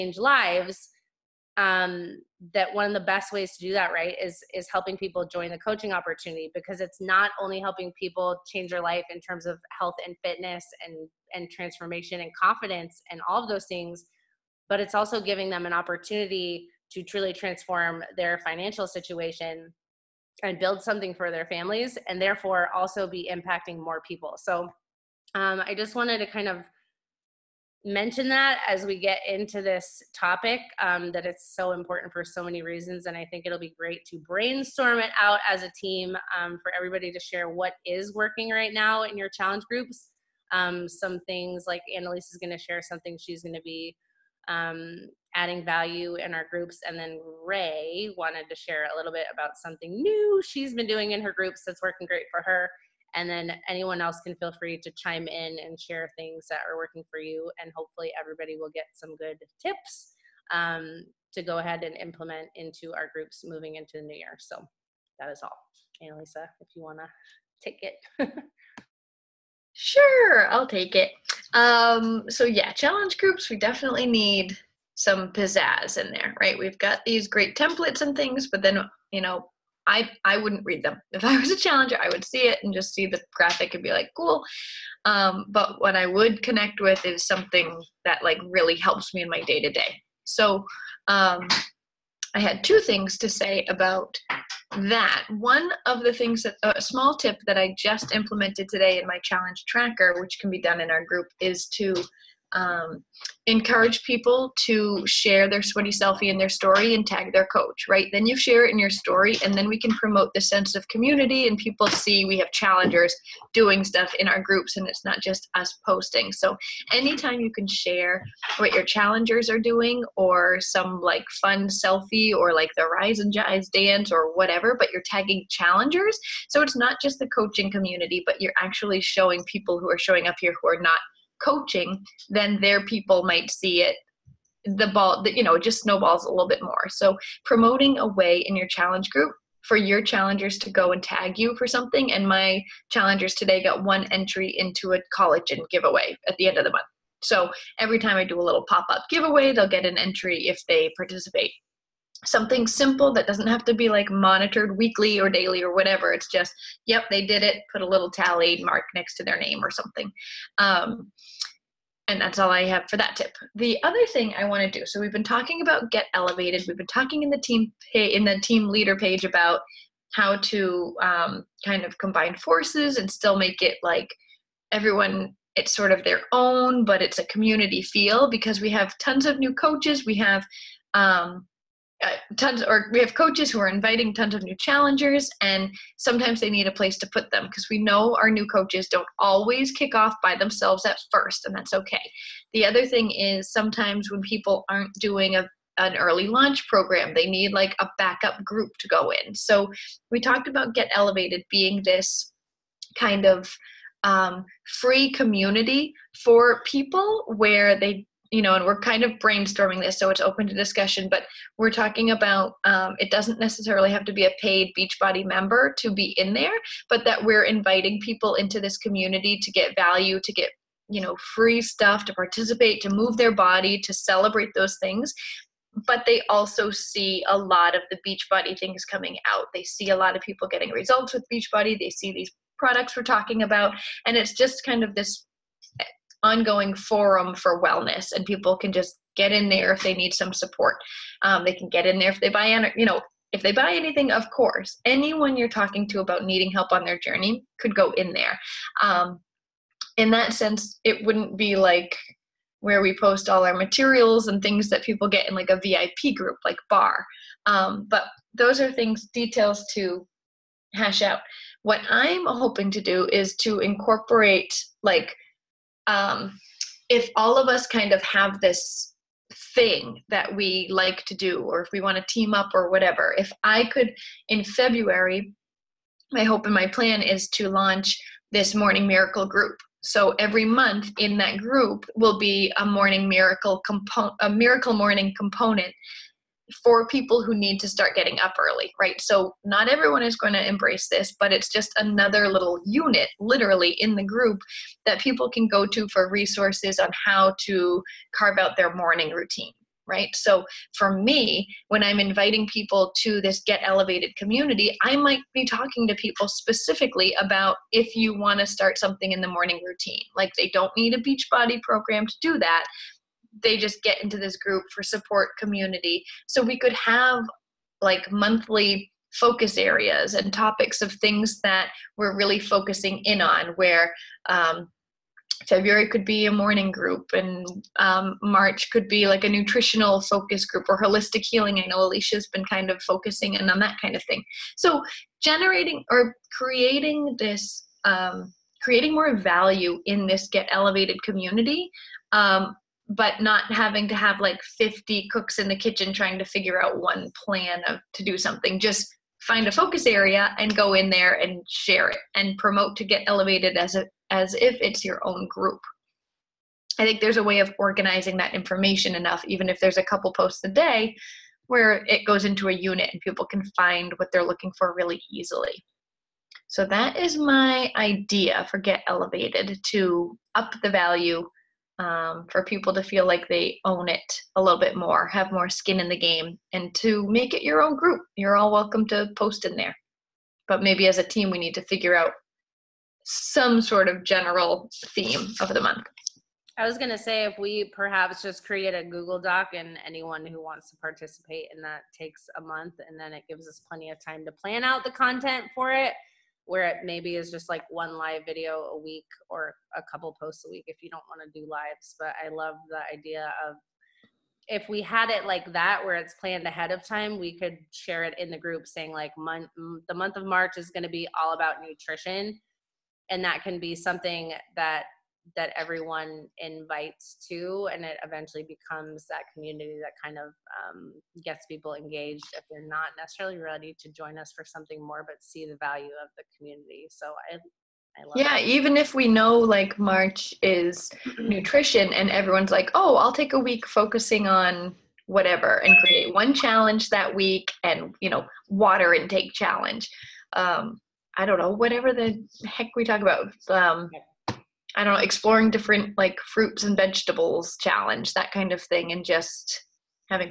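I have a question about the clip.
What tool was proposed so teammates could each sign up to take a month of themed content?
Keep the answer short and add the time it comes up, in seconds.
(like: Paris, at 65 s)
Google Doc, at 388 s.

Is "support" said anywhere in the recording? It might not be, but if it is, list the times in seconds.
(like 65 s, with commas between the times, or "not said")
240 s, 314 s.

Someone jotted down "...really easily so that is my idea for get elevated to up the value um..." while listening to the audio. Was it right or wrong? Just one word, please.
right.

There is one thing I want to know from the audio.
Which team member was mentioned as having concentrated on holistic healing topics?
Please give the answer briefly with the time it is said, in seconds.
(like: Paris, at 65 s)
Alicia, at 331 s.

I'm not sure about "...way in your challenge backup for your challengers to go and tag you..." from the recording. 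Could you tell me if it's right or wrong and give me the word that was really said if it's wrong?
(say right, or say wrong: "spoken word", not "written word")
wrong: "group", not "backup".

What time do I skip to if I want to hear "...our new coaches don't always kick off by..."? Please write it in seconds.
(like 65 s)
188 s.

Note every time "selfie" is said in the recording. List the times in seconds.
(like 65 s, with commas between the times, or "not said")
105 s, 121 s.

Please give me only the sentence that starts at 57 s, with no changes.
And hopefully, everybody will get some good tips um, to go ahead and implement into our groups moving into the new year.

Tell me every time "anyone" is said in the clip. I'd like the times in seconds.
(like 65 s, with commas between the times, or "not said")
53 s, 244 s, 389 s.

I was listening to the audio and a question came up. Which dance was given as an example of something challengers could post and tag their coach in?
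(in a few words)
Rise and Jive.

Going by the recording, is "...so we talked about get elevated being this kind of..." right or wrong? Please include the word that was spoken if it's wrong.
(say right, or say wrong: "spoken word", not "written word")
right.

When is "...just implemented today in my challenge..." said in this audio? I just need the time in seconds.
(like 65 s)
97 s.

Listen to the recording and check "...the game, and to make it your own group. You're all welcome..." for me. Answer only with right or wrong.
right.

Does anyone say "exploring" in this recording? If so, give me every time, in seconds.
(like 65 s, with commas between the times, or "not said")
445 s.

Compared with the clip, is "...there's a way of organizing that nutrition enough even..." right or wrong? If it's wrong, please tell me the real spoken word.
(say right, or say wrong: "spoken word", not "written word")
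wrong: "information", not "nutrition".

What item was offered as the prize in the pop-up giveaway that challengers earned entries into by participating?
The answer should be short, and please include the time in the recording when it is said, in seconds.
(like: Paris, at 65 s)
Collagen, at 145 s.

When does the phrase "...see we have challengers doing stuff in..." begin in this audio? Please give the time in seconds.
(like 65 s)
111 s.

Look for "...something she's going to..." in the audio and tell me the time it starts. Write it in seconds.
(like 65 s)
42 s.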